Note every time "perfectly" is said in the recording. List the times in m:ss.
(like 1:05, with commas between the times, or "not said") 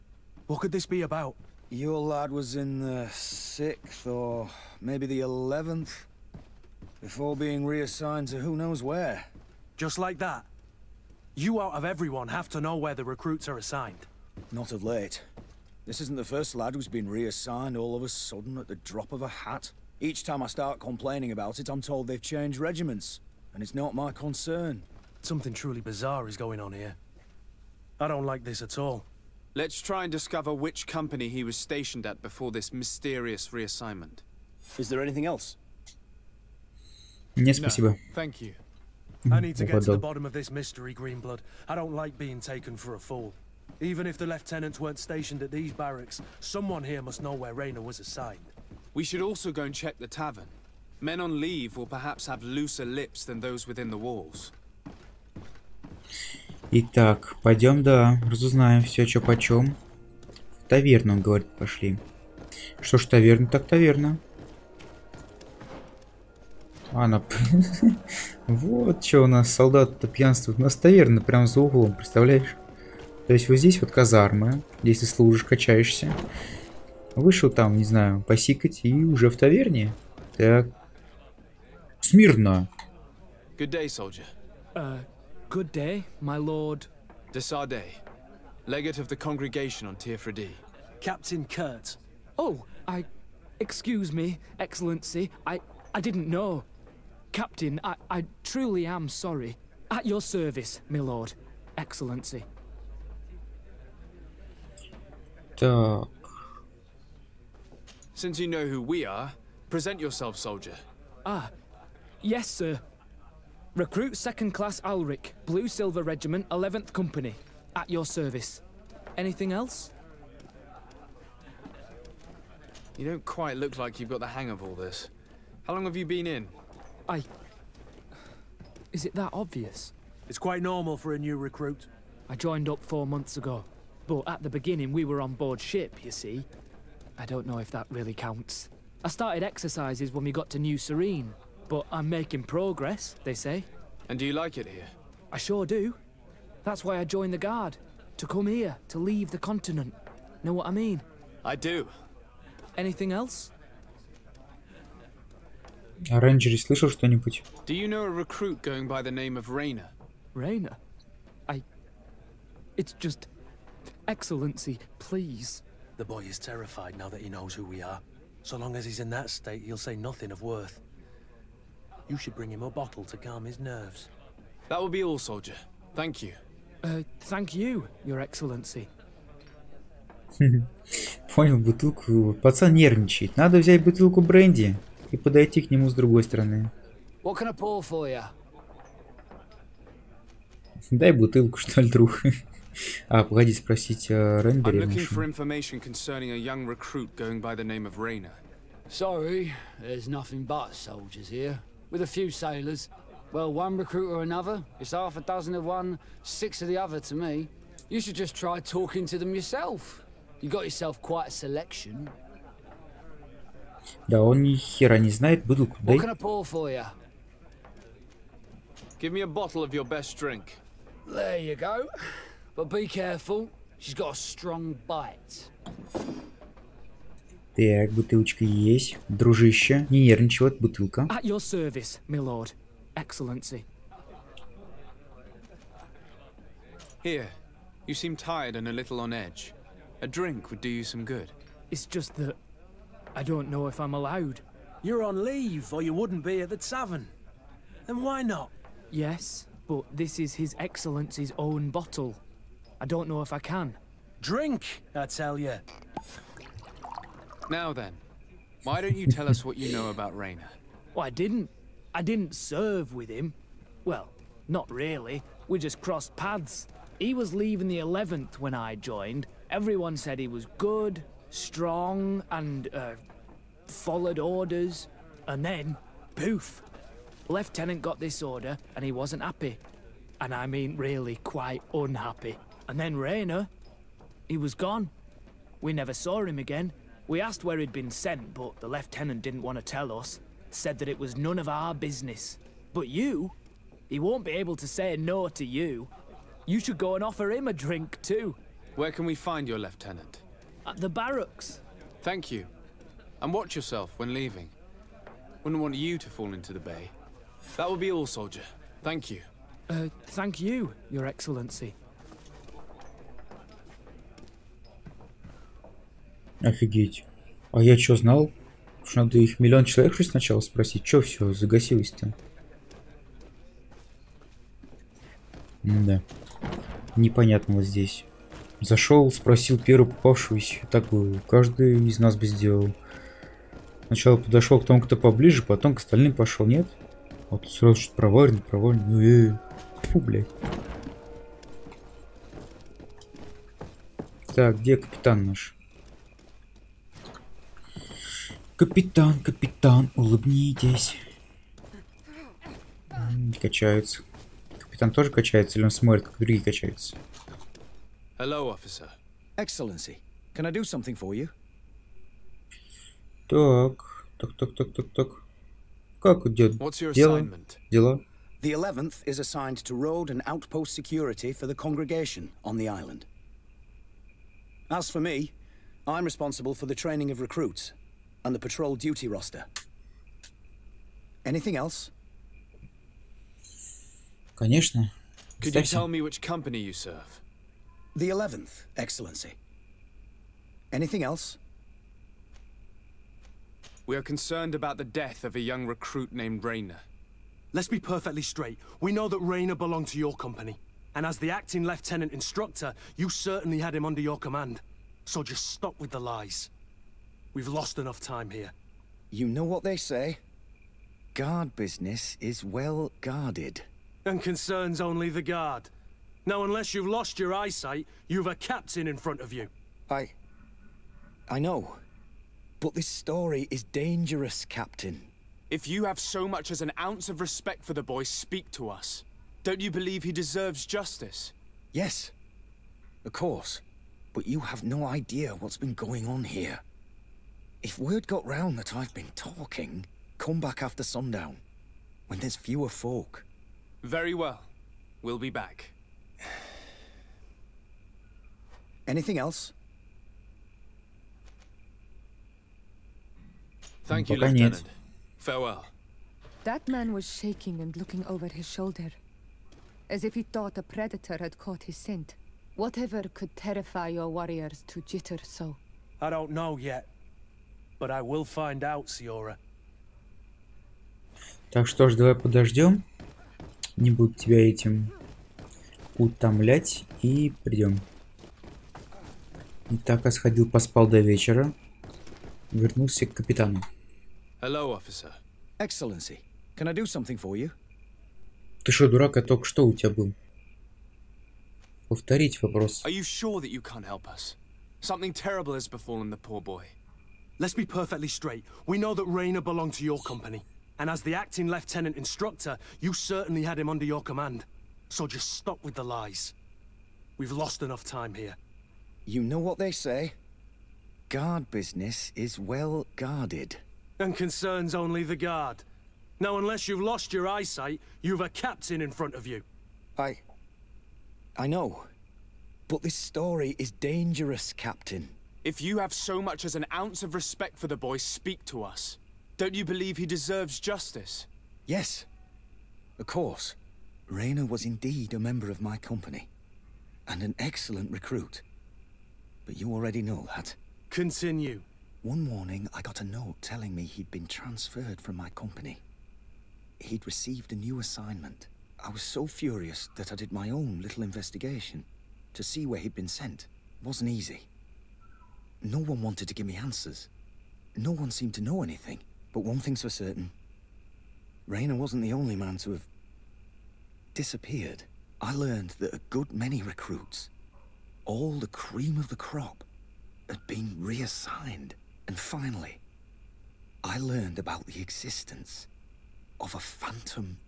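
6:37, 8:17.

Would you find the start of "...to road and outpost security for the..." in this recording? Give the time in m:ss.
6:09.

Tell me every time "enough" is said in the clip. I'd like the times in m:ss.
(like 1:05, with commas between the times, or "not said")
6:47, 8:27.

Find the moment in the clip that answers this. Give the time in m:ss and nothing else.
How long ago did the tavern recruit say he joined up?
2:12.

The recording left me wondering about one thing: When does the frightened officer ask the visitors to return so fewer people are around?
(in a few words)
after sundown.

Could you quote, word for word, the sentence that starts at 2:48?
So long as he's in that state, he'll say nothing of worth.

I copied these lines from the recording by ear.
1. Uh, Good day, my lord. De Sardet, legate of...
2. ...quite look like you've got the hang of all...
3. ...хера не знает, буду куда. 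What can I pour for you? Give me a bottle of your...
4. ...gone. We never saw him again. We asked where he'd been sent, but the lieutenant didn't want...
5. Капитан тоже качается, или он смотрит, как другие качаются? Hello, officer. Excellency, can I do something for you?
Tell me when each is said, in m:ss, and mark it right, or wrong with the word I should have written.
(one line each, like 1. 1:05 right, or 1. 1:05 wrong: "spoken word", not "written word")
1. 1:24 right
2. 2:03 right
3. 3:34 right
4. 4:44 right
5. 5:54 right.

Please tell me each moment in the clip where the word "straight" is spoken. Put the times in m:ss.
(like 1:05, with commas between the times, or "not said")
6:38, 8:18.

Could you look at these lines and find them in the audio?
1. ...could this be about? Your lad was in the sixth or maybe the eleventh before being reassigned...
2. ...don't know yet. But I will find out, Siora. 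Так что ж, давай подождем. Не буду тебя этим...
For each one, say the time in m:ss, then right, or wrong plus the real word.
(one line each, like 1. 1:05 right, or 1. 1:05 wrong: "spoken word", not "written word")
1. 0:00 right
2. 7:46 right.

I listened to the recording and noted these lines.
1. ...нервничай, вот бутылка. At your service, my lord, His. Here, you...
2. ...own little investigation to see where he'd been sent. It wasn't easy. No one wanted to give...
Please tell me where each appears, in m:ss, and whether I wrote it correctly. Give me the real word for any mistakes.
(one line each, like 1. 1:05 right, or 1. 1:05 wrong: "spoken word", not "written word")
1. 3:50 wrong: "Excellency", not "His"
2. 9:10 right.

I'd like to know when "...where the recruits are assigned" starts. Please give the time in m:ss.
0:12.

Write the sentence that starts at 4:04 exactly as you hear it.
You're on leave, or you wouldn't be at the tavern.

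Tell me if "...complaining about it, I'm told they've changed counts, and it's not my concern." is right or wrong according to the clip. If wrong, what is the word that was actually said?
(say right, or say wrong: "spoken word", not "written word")
wrong: "regiments", not "counts".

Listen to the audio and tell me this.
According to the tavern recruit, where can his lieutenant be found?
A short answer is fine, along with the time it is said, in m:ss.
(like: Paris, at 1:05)
At the barracks, at 5:00.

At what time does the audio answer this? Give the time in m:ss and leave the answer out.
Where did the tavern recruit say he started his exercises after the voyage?
2:20.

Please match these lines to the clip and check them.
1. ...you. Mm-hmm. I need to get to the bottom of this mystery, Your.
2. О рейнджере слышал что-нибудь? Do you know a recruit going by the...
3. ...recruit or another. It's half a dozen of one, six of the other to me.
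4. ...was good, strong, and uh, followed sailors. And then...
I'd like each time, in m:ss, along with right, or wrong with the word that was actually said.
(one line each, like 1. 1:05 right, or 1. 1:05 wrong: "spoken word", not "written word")
1. 0:38 wrong: "Greenblood", not "Your"
2. 2:36 right
3. 3:23 right
4. 4:30 wrong: "orders", not "sailors".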